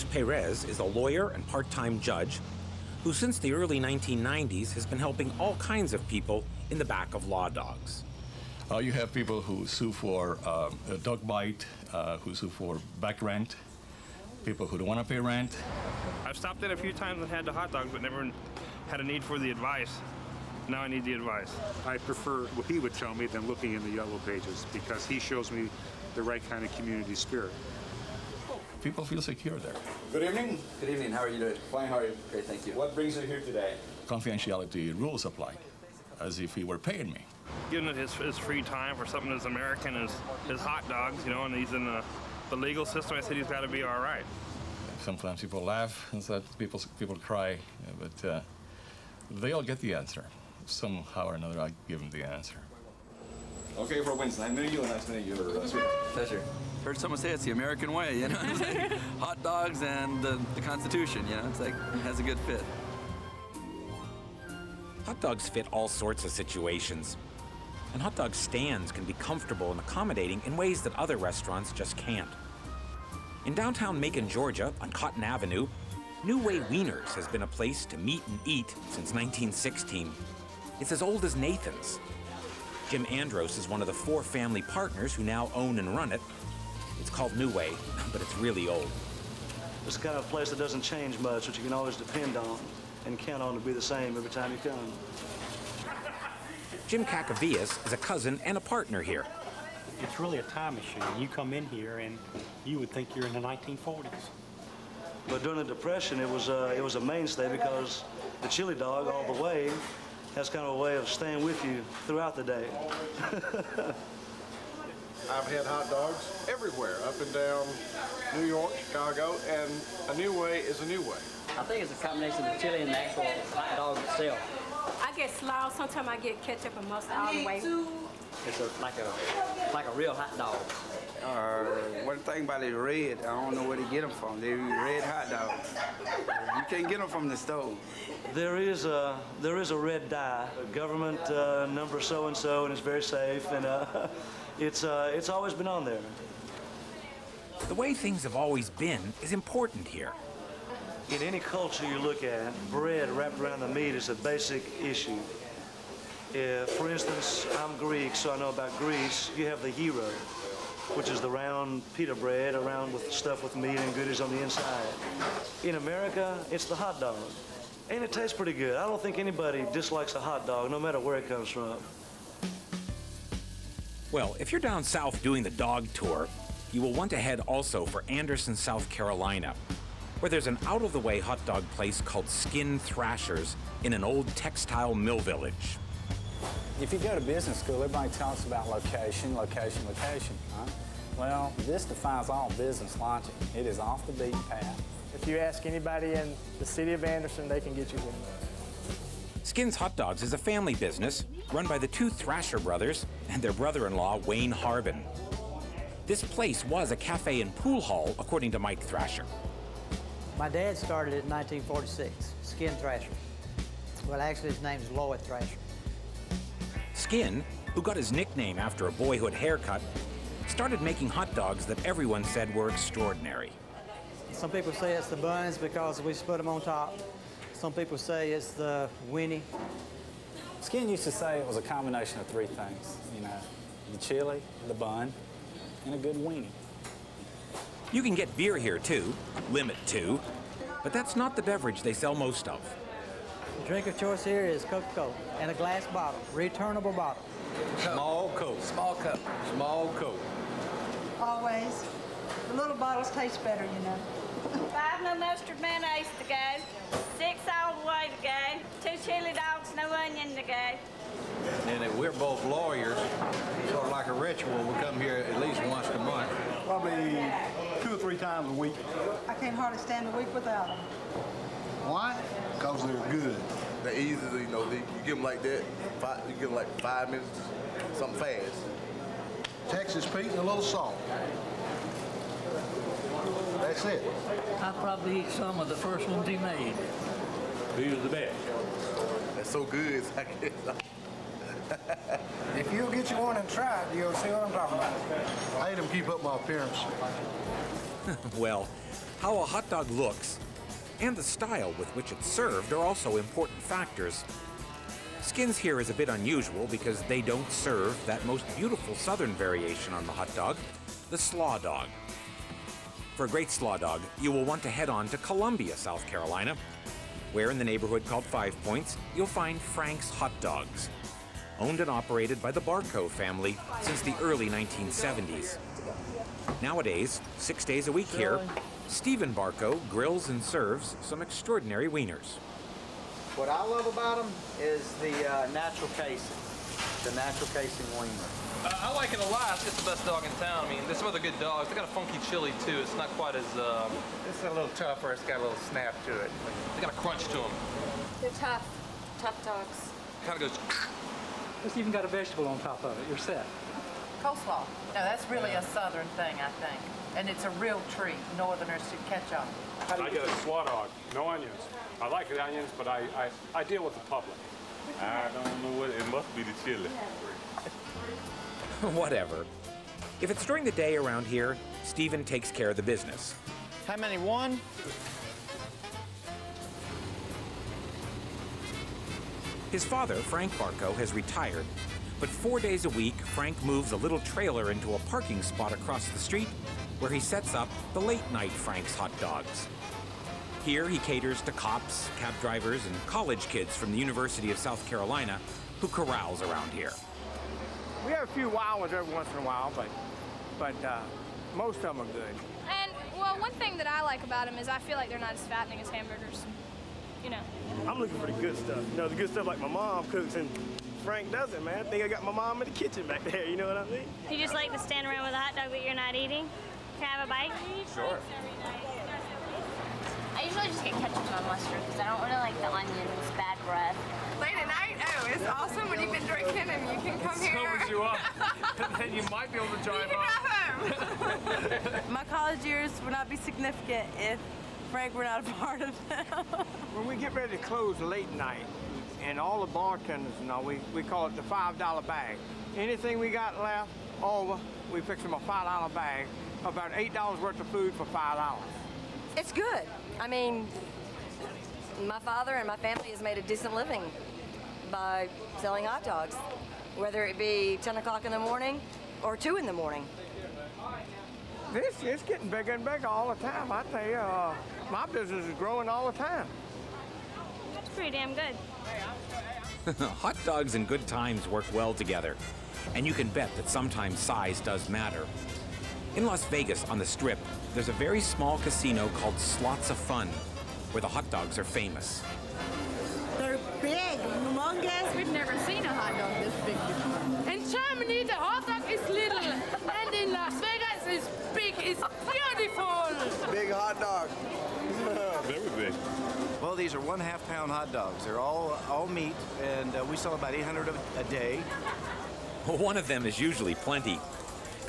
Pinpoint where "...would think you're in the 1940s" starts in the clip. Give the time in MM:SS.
01:42.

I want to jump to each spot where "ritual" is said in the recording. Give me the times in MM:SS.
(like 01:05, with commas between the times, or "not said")
04:24.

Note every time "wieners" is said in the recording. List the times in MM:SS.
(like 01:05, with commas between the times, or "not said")
05:31, 05:37.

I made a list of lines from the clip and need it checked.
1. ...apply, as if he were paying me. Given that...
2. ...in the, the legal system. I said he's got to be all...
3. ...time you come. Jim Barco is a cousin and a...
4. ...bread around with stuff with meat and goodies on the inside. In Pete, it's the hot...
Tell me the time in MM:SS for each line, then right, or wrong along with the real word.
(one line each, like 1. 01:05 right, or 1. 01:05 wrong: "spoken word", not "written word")
1. 00:35 right
2. 00:41 right
3. 01:34 wrong: "Cacavias", not "Barco"
4. 02:42 wrong: "America", not "Pete".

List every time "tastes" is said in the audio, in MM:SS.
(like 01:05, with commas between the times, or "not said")
02:48, 04:13.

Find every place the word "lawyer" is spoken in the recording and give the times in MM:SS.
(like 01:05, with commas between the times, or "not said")
00:00, 04:22.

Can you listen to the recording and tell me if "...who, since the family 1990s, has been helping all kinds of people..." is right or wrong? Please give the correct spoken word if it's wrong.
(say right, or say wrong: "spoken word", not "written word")
wrong: "early", not "family".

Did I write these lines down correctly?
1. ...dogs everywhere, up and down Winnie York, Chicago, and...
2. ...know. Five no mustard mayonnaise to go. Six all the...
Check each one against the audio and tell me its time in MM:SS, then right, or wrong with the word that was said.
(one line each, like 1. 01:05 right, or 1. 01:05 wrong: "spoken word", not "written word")
1. 01:55 wrong: "New", not "Winnie"
2. 04:13 right.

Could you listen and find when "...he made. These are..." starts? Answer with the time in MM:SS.
04:46.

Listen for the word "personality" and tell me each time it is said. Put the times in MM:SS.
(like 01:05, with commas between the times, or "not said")
not said.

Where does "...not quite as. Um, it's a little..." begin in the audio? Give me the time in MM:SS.
05:42.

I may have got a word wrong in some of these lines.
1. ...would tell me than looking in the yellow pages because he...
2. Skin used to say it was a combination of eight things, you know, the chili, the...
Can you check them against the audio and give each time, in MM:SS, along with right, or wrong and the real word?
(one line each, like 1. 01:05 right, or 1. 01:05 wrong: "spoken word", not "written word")
1. 00:22 right
2. 03:50 wrong: "three", not "eight".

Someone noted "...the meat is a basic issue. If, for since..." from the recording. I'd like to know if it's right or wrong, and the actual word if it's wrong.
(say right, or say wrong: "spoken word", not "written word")
wrong: "instance", not "since".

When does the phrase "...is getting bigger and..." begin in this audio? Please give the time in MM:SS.
07:42.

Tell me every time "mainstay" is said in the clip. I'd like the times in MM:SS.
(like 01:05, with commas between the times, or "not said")
01:46.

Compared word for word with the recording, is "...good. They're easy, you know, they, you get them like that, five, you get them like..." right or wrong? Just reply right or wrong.
right.